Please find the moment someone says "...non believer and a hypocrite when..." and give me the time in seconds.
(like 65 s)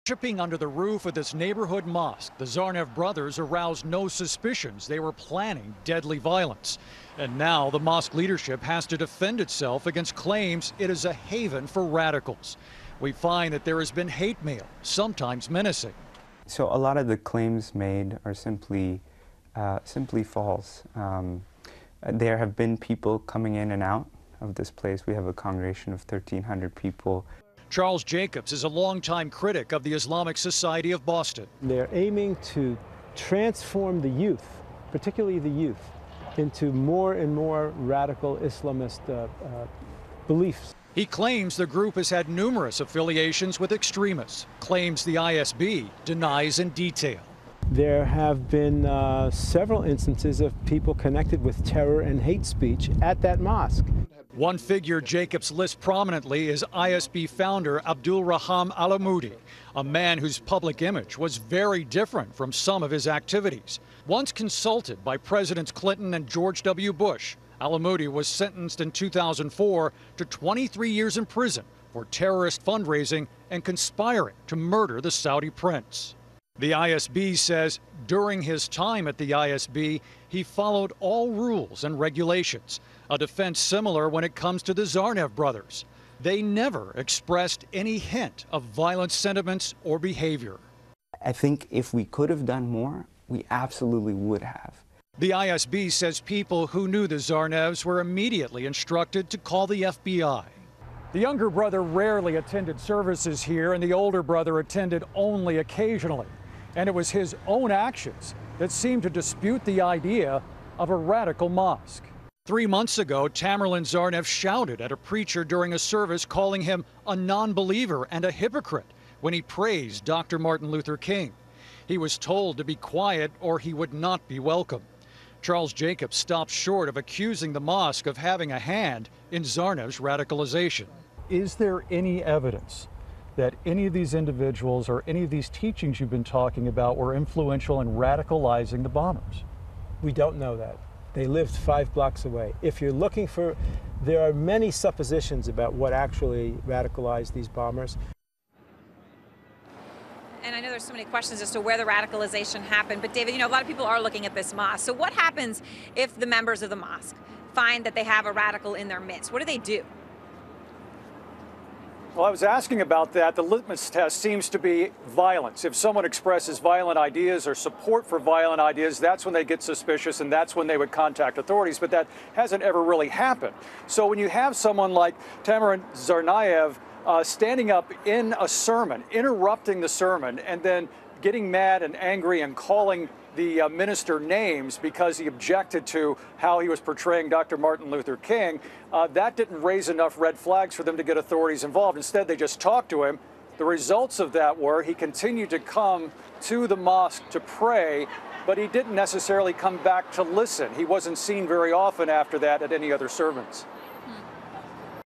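117 s.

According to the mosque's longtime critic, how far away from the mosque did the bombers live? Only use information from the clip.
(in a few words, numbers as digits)
5 blocks.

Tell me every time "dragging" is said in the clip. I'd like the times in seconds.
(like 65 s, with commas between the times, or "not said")
not said.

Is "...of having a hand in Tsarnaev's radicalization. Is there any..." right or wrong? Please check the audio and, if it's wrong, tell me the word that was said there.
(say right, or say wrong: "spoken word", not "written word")
right.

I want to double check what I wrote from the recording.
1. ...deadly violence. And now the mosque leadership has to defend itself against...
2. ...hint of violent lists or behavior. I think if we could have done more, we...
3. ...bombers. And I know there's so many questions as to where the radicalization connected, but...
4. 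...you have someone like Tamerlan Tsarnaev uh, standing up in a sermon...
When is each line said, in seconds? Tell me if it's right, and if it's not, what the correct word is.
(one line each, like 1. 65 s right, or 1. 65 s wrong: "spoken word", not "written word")
1. 5 s right
2. 87 s wrong: "sentiments", not "lists"
3. 147 s wrong: "happened", not "connected"
4. 174 s right.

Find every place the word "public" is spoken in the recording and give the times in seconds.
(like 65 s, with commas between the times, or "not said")
60 s.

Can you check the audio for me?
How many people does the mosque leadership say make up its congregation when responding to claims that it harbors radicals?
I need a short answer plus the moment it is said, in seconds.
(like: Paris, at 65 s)
1,300, at 26 s.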